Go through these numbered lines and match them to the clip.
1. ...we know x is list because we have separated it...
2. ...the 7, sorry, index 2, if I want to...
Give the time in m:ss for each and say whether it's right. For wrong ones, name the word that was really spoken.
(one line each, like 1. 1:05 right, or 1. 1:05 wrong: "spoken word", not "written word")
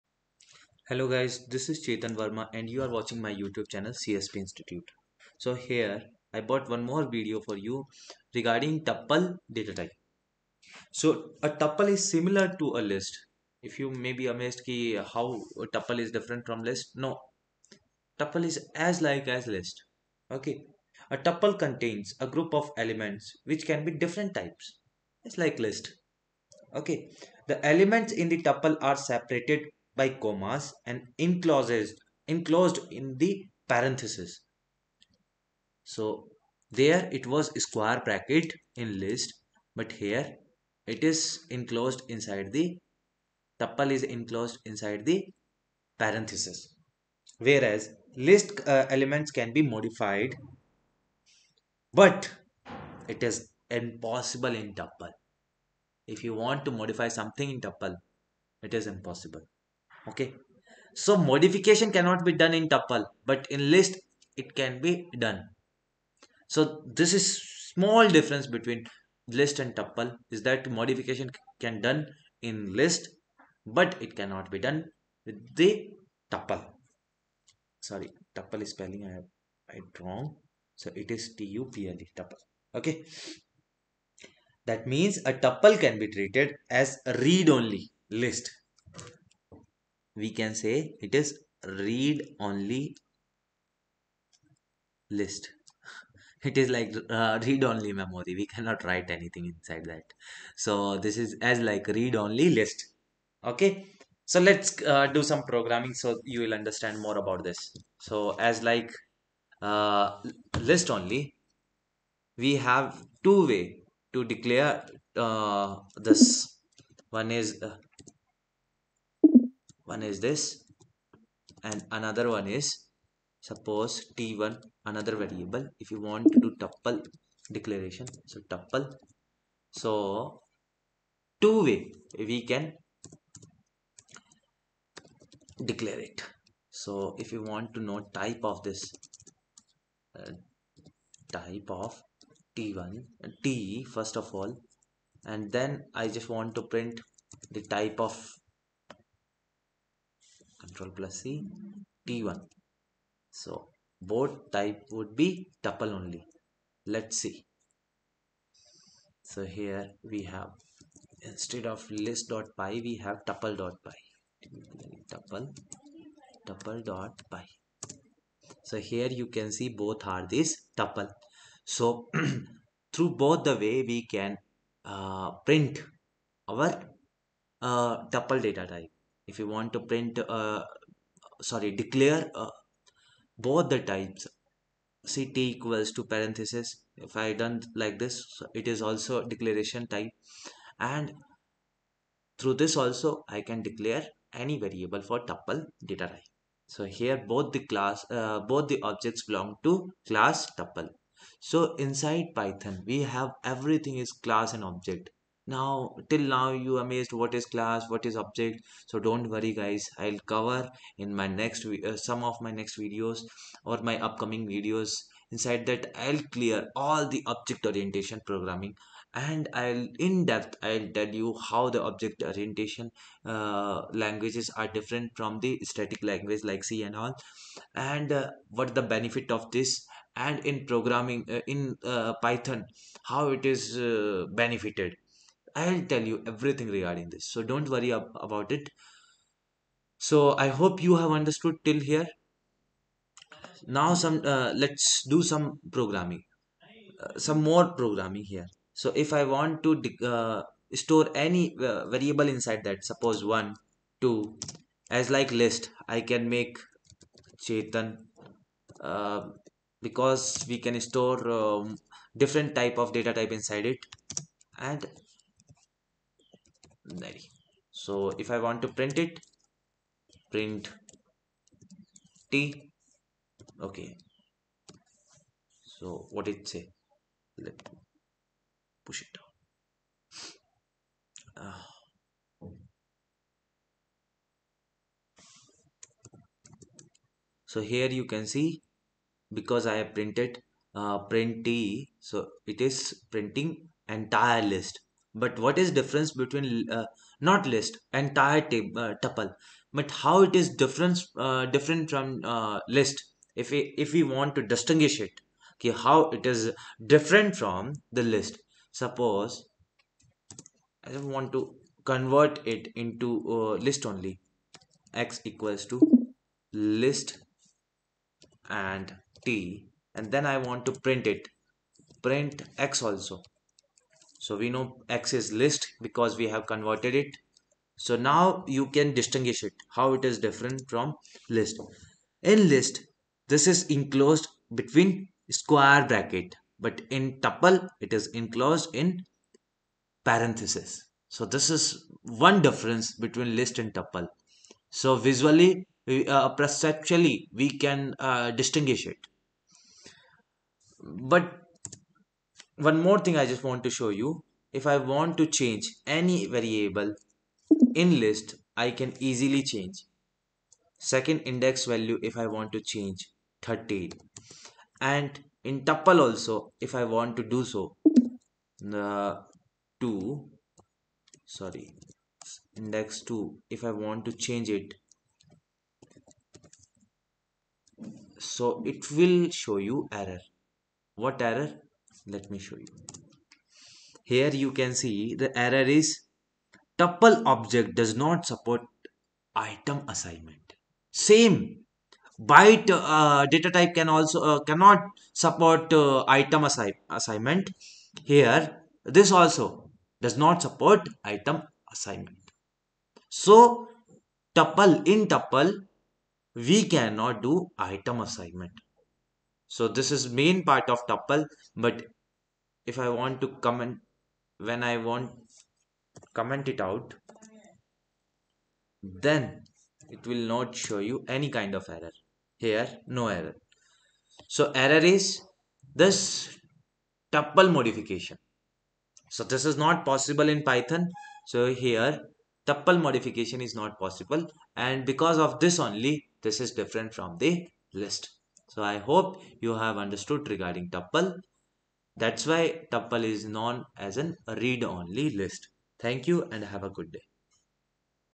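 1. 5:24 wrong: "converted", not "separated"
2. 6:08 wrong: "2", not "7".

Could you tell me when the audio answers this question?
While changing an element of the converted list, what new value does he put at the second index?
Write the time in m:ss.
6:03.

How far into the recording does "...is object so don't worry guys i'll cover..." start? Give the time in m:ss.
3:28.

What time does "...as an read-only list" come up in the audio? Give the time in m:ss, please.
7:23.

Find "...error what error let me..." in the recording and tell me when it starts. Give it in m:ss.
6:19.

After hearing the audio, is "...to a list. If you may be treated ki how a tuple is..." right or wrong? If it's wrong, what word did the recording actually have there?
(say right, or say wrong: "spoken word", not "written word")
wrong: "amazed", not "treated".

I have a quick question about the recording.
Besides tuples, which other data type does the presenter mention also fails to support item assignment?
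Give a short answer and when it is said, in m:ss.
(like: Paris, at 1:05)
byte, at 6:32.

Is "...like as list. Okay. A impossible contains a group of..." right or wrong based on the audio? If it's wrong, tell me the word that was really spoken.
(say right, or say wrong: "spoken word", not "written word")
wrong: "tuple", not "impossible".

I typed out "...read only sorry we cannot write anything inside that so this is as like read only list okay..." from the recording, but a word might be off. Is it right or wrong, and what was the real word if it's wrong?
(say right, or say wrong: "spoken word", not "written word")
wrong: "memory", not "sorry".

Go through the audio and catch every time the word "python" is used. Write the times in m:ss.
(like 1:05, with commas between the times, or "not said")
3:22, 3:52, 7:10.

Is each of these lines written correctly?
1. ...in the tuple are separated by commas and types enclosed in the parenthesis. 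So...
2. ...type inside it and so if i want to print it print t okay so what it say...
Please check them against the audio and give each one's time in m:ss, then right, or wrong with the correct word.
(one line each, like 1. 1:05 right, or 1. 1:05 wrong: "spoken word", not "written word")
1. 0:28 wrong: "encloses", not "types"
2. 4:23 right.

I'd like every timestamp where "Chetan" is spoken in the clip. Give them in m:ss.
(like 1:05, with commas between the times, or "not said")
0:01, 4:17.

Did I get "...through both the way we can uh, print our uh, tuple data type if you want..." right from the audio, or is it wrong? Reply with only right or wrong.
right.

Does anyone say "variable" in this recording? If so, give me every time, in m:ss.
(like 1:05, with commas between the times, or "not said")
2:05, 3:14, 4:11, 5:56.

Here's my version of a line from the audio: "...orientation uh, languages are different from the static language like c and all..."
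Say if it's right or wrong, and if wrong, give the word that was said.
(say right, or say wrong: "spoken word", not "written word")
right.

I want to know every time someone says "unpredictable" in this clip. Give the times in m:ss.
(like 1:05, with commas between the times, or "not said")
not said.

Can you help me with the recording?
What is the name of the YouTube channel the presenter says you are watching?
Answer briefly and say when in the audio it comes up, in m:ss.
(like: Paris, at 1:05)
CSP Institute, at 0:03.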